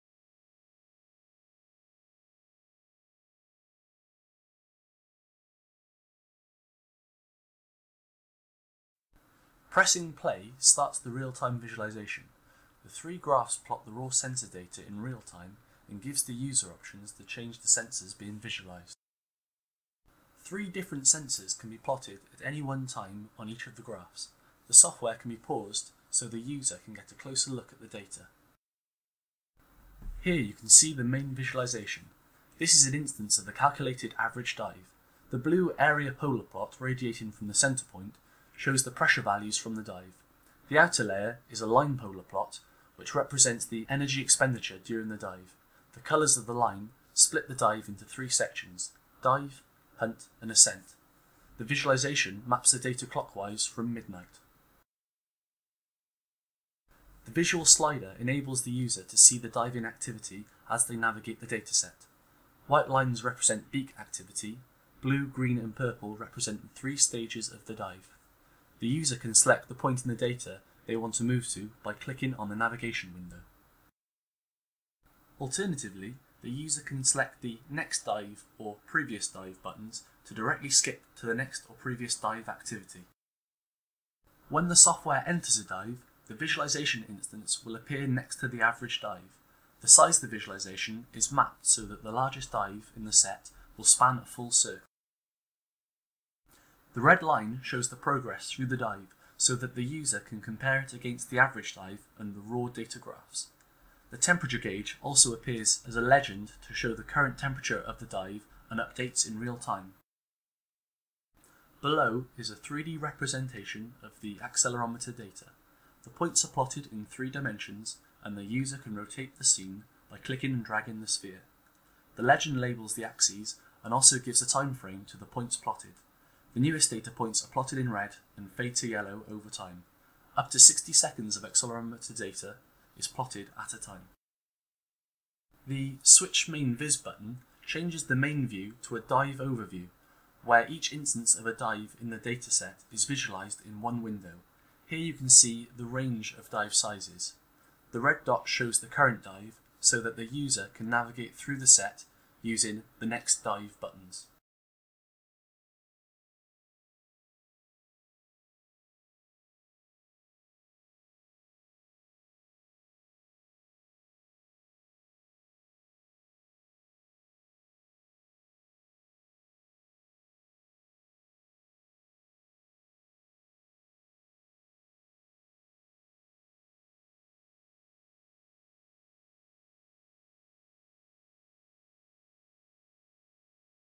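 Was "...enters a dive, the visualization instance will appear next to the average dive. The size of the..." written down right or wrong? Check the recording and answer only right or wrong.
right.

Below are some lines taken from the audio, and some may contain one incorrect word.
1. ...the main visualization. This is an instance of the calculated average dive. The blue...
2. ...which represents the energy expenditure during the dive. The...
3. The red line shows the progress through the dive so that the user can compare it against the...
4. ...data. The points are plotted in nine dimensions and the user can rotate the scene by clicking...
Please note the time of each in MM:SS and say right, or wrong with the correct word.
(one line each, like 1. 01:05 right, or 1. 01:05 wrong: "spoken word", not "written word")
1. 00:30 right
2. 00:42 right
3. 01:36 right
4. 01:55 wrong: "three", not "nine".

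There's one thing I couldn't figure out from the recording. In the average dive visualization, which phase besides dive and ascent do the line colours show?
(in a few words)
hunt.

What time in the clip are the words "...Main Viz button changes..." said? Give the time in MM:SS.
02:16.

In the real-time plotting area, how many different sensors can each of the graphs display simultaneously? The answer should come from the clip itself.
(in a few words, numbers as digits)
3.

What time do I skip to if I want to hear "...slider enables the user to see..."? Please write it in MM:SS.
00:57.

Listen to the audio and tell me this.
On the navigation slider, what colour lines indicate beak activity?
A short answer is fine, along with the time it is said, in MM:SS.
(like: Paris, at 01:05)
White, at 01:02.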